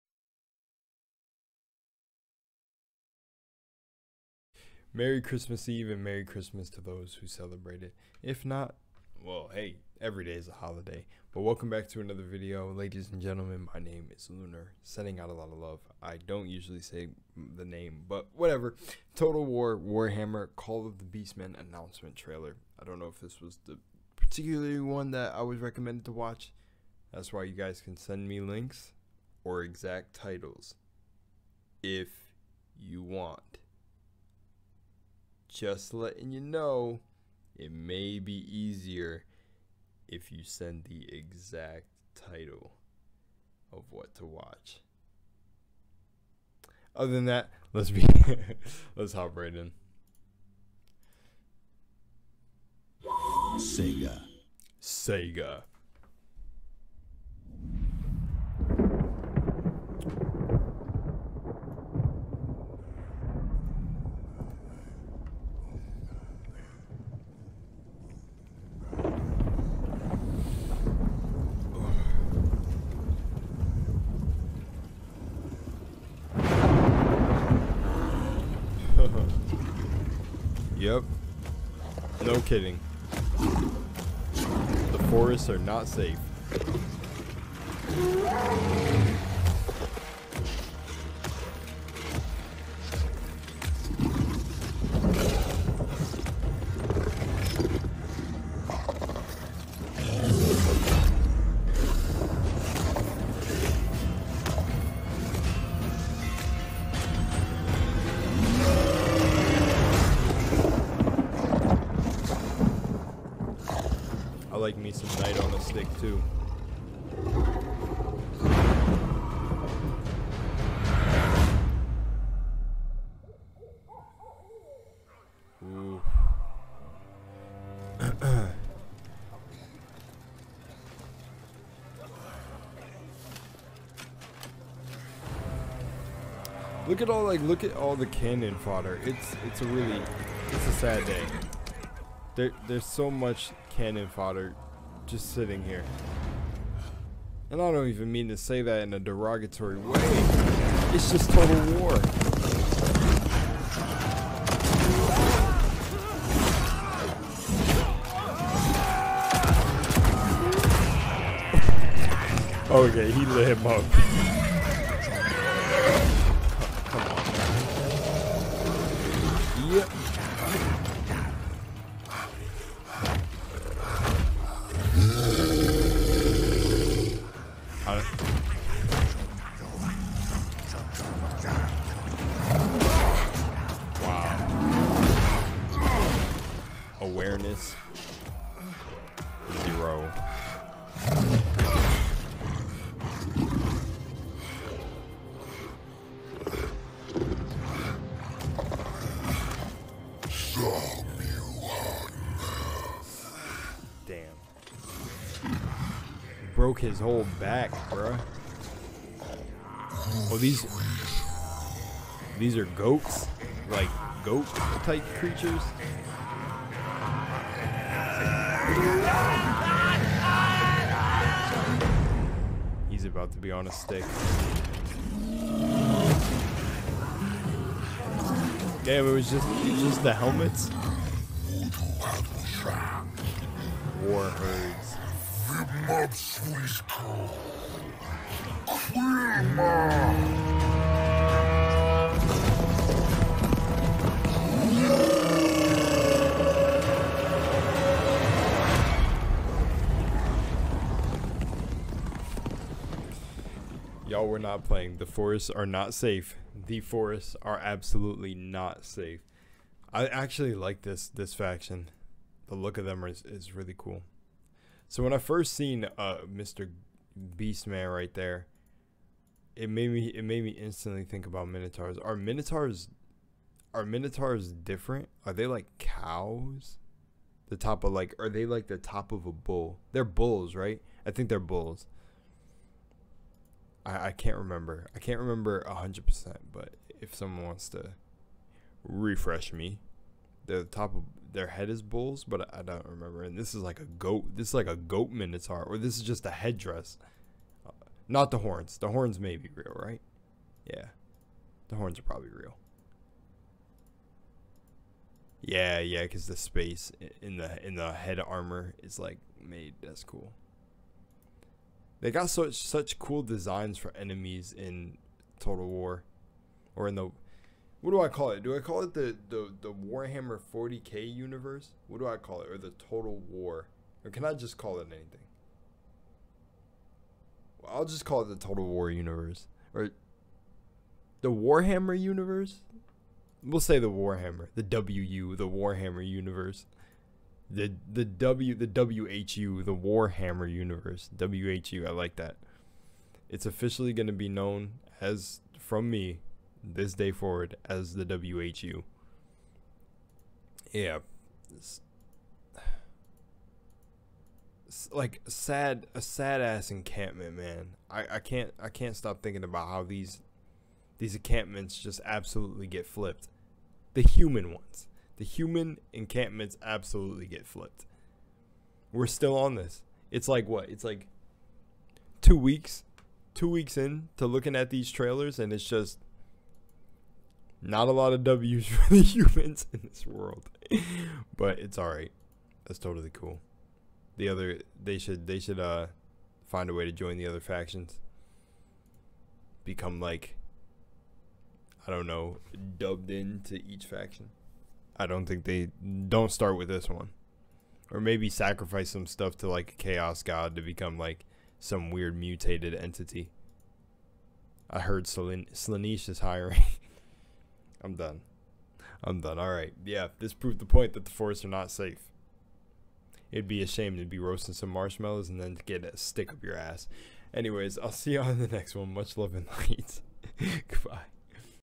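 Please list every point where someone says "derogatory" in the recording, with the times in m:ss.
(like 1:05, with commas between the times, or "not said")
2:28.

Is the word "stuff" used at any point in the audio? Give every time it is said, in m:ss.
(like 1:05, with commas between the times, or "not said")
6:39.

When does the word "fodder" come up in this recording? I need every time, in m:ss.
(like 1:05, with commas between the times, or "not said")
2:18, 2:24.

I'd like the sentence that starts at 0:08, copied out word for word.
If not, well, hey, every day is a holiday.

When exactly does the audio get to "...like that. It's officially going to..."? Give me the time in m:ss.
5:41.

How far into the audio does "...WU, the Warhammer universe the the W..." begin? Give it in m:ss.
5:34.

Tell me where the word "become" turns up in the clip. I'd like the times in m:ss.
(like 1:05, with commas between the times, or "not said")
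6:29, 6:40.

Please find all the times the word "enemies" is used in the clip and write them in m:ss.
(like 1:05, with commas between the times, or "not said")
5:13.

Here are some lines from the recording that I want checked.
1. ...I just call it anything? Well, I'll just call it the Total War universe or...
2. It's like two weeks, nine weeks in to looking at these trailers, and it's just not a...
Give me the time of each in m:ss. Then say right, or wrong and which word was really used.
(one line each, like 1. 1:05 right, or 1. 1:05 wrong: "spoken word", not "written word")
1. 5:24 right
2. 6:10 wrong: "two", not "nine".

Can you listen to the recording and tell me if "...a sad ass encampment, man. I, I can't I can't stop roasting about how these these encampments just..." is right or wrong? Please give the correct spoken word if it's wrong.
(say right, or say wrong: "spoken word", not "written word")
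wrong: "thinking", not "roasting".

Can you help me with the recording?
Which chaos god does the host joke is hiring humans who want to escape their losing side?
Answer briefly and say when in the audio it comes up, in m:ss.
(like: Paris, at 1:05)
Slaanesh, at 6:45.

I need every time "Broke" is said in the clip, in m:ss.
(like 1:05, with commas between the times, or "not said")
3:26.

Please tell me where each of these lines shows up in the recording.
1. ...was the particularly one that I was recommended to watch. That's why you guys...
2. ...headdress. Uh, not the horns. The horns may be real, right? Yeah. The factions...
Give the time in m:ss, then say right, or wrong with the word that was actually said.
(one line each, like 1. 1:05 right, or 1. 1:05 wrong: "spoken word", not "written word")
1. 0:23 right
2. 4:56 wrong: "horns", not "factions".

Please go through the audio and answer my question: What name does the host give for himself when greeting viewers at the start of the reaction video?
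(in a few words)
Lunar.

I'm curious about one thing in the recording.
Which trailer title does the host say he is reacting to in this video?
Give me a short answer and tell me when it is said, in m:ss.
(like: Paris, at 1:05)
Total War Warhammer Call of the Beastmen, at 0:19.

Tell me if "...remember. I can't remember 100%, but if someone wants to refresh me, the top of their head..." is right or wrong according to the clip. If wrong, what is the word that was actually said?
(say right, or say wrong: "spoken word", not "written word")
right.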